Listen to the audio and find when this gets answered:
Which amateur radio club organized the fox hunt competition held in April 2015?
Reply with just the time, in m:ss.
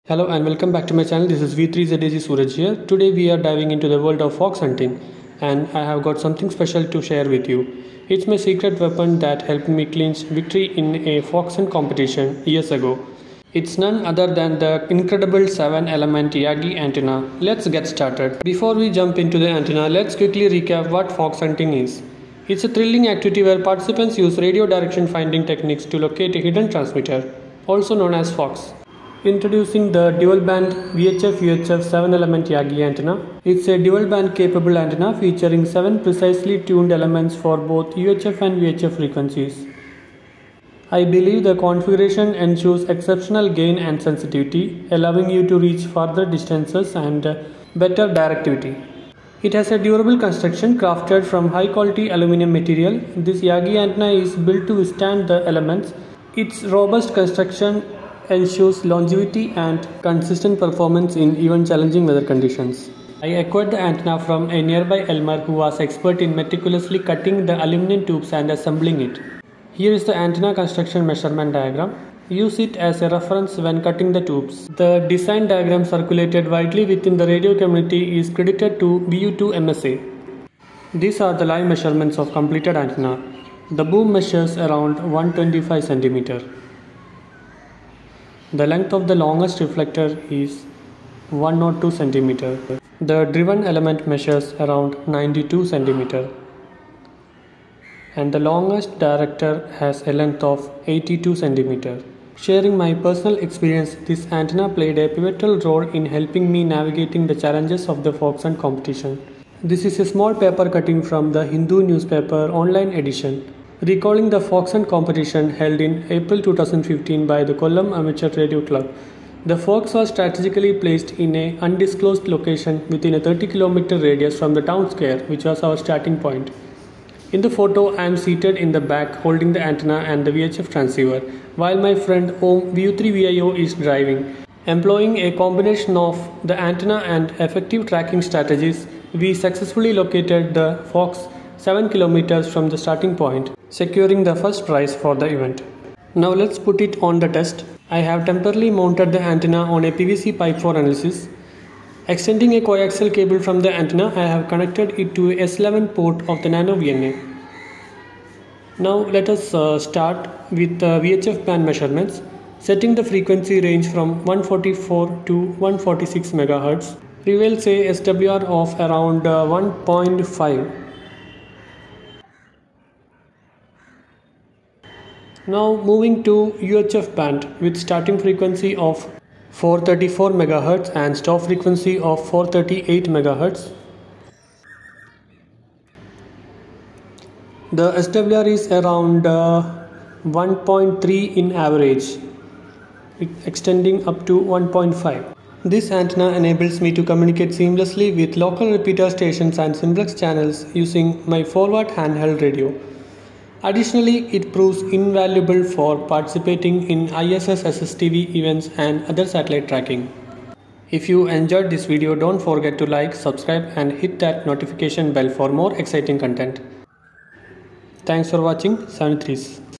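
1:57.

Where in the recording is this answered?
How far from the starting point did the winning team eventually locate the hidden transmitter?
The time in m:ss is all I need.
2:21.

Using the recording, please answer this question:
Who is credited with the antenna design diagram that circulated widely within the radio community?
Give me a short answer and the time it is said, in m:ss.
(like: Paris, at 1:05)
VU2 MSA, at 1:19.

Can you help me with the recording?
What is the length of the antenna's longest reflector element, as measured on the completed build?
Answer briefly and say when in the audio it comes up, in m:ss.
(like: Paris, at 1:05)
102 cm, at 1:31.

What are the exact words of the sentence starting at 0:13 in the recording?
It's none other than the incredible 7 element Yagi antenna.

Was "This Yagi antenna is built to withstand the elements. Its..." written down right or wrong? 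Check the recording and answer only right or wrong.
right.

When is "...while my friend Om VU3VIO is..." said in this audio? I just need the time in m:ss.
2:11.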